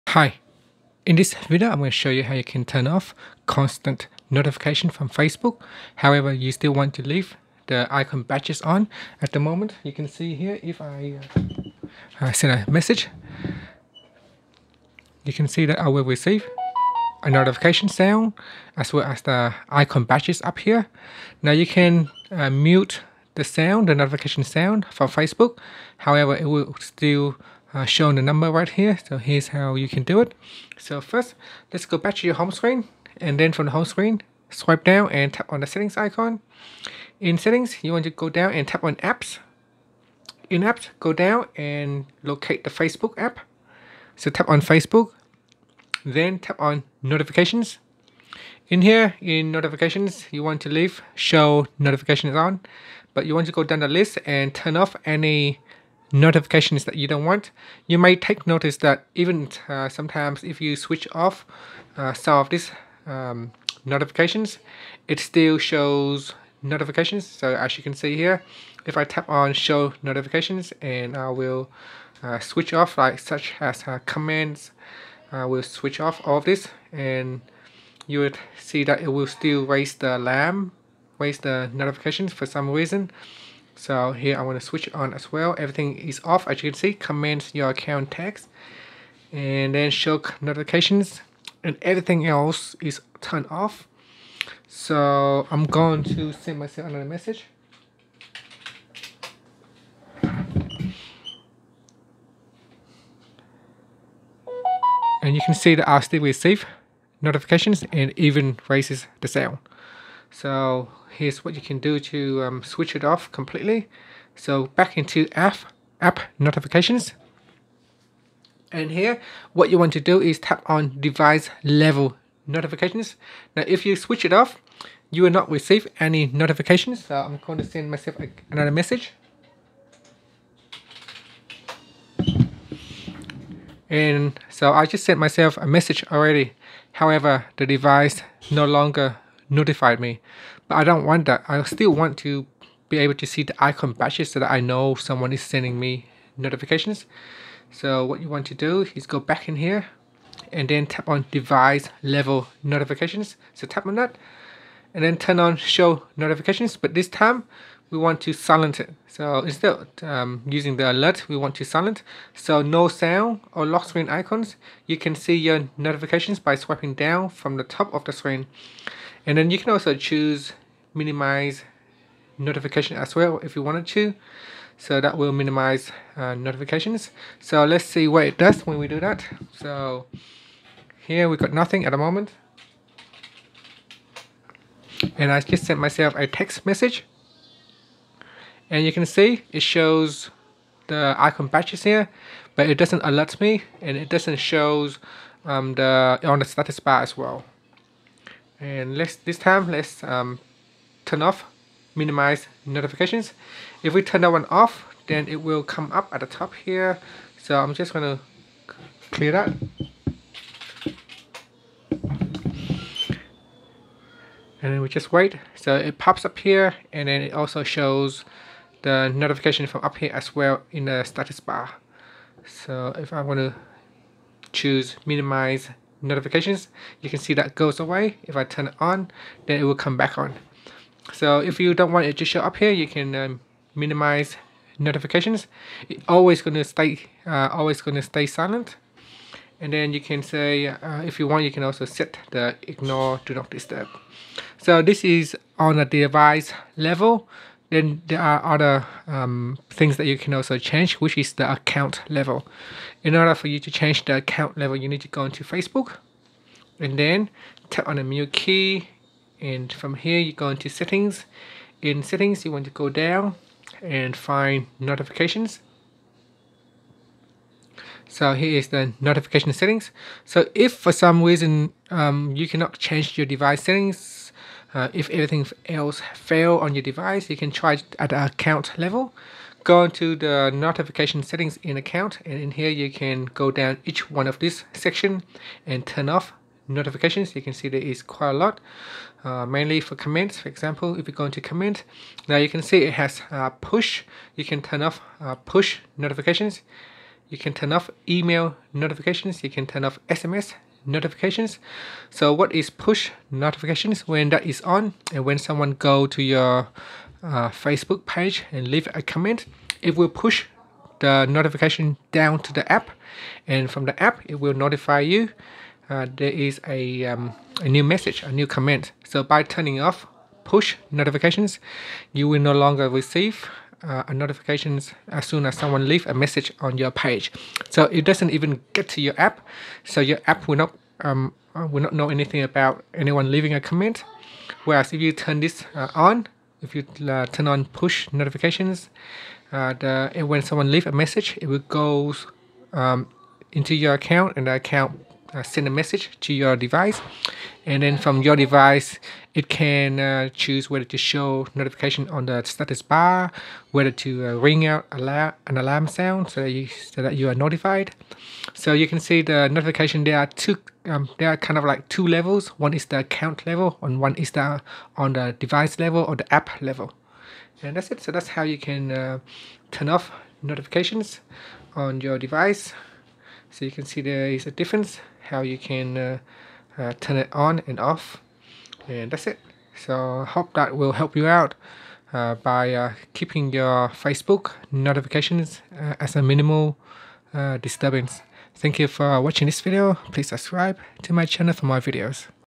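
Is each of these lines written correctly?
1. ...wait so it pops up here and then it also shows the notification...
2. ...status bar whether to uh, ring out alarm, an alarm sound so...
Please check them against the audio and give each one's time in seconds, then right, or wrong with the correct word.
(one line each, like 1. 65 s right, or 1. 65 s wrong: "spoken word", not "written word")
1. 215 s right
2. 352 s right.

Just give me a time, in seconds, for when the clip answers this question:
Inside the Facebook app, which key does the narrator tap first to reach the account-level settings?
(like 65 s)
258 s.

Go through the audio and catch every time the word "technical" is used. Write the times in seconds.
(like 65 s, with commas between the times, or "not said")
not said.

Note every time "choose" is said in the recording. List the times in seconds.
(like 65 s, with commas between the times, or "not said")
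169 s, 224 s, 350 s.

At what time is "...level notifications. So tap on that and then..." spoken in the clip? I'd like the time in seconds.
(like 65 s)
152 s.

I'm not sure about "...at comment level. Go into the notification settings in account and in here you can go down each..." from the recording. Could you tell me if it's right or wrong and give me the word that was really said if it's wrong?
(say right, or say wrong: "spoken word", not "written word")
wrong: "account", not "comment".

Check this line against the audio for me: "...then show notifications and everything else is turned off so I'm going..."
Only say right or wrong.
right.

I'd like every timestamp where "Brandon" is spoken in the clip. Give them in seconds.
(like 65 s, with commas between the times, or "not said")
not said.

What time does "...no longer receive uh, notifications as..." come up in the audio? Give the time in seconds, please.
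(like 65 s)
322 s.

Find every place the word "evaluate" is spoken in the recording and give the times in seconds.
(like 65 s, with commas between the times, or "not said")
not said.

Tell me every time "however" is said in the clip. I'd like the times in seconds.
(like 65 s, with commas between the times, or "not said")
6 s, 25 s, 136 s.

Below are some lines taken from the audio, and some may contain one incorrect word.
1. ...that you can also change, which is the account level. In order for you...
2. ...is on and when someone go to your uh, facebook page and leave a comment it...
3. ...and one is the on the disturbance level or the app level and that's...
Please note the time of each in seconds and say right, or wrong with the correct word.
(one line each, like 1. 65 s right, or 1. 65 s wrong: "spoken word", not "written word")
1. 249 s right
2. 304 s right
3. 363 s wrong: "device", not "disturbance".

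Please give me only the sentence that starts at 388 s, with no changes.
Thank you for watching this video.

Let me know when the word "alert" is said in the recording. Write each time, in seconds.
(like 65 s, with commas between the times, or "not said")
160 s, 193 s.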